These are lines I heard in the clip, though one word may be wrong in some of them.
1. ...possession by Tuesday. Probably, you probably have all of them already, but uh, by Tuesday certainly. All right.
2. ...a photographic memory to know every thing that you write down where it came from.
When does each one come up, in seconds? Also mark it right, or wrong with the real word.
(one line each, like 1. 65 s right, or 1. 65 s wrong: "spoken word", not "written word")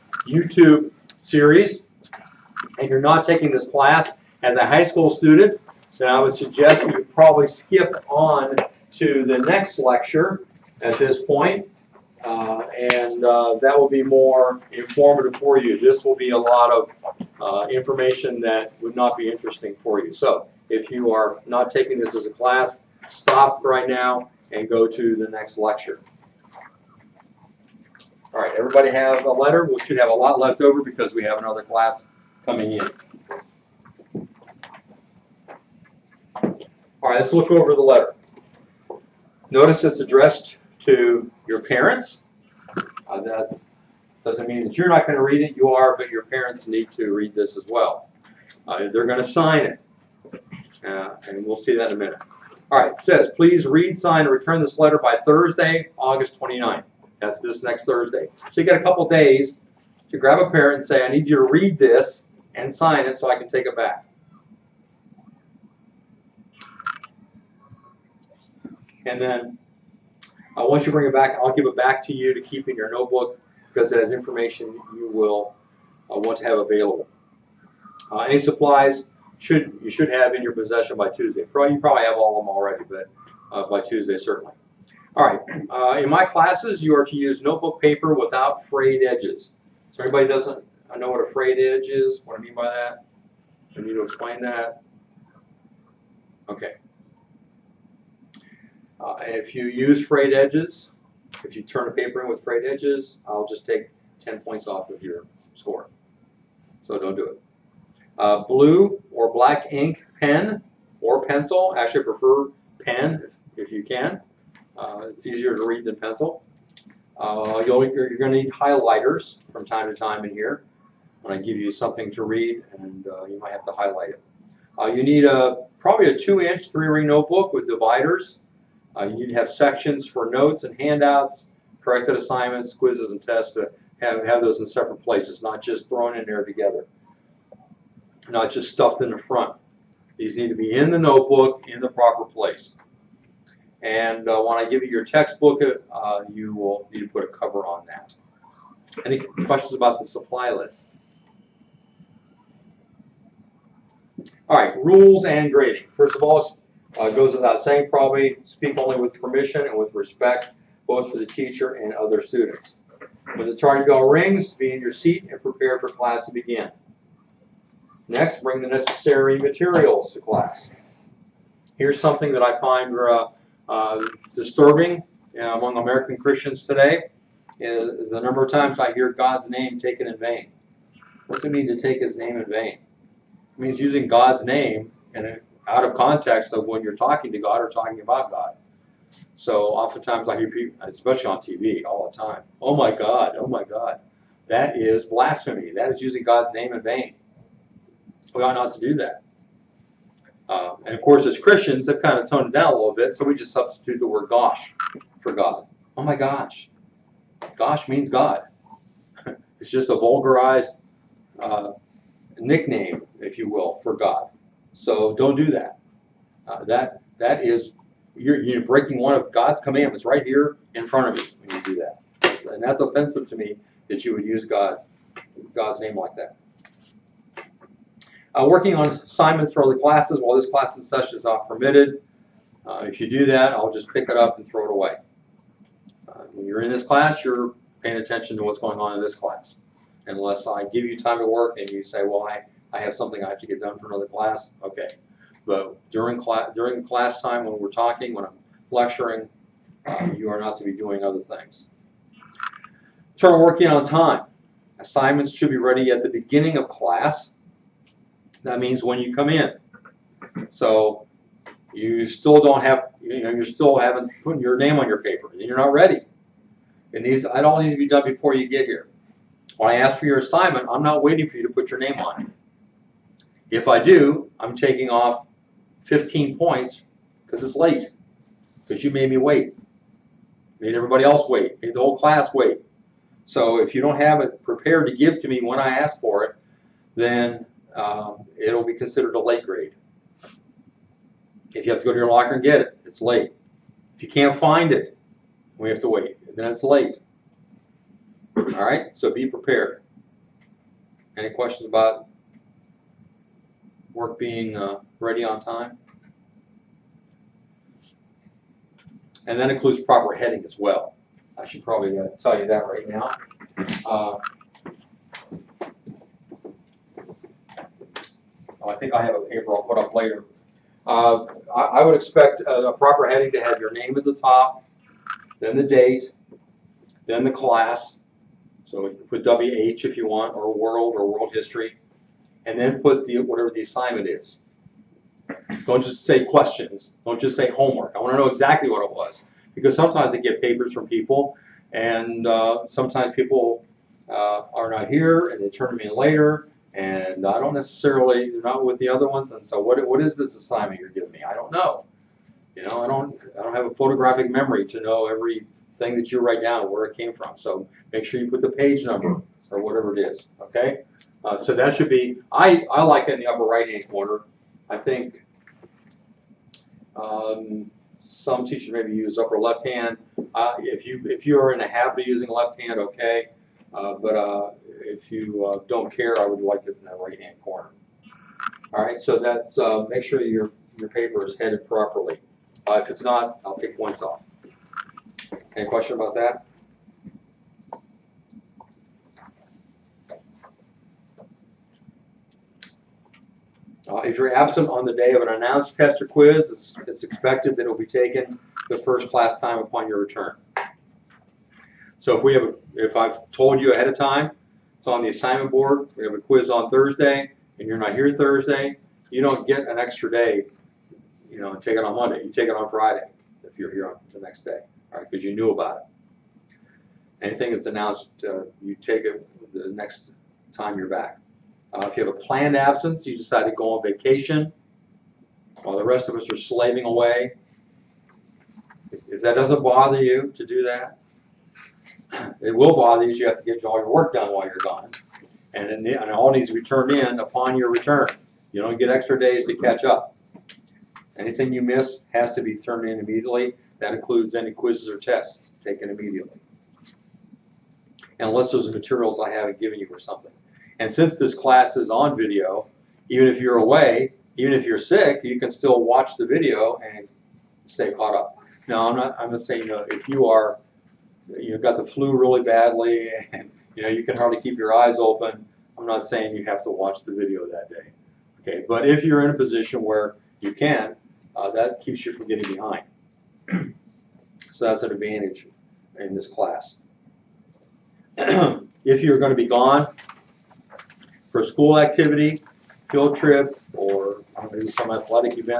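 1. 80 s right
2. 353 s right.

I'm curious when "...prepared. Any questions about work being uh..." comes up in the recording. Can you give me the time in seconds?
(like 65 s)
299 s.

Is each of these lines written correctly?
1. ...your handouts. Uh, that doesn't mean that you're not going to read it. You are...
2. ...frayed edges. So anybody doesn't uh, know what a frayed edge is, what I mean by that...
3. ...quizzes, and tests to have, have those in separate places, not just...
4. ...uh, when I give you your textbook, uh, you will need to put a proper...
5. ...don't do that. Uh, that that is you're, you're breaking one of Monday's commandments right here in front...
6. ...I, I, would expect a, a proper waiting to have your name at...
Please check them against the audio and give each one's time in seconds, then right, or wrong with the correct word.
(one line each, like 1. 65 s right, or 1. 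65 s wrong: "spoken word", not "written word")
1. 41 s wrong: "parents", not "handouts"
2. 88 s right
3. 132 s right
4. 144 s wrong: "cover", not "proper"
5. 215 s wrong: "God", not "Monday"
6. 321 s wrong: "heading", not "waiting".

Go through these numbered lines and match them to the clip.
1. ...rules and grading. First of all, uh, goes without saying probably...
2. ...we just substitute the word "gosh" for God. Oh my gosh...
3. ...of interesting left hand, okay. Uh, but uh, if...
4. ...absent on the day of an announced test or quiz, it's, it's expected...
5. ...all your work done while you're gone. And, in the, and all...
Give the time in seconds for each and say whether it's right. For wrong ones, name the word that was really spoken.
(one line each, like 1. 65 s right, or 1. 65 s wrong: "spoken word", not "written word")
1. 154 s right
2. 203 s right
3. 372 s wrong: "using", not "interesting"
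4. 394 s right
5. 433 s right.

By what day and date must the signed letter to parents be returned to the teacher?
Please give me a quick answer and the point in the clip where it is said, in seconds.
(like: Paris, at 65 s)
Thursday, August 29th, at 55 s.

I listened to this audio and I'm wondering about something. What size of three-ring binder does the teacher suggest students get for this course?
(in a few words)
2-inch.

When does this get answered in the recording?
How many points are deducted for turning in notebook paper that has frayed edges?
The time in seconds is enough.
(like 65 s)
104 s.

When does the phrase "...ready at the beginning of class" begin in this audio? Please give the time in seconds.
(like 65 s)
255 s.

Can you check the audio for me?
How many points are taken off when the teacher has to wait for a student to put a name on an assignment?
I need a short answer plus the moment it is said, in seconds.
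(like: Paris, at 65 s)
15, at 275 s.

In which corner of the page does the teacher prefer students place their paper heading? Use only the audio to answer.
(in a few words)
upper right-hand corner.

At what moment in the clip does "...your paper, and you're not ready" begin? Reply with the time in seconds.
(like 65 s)
264 s.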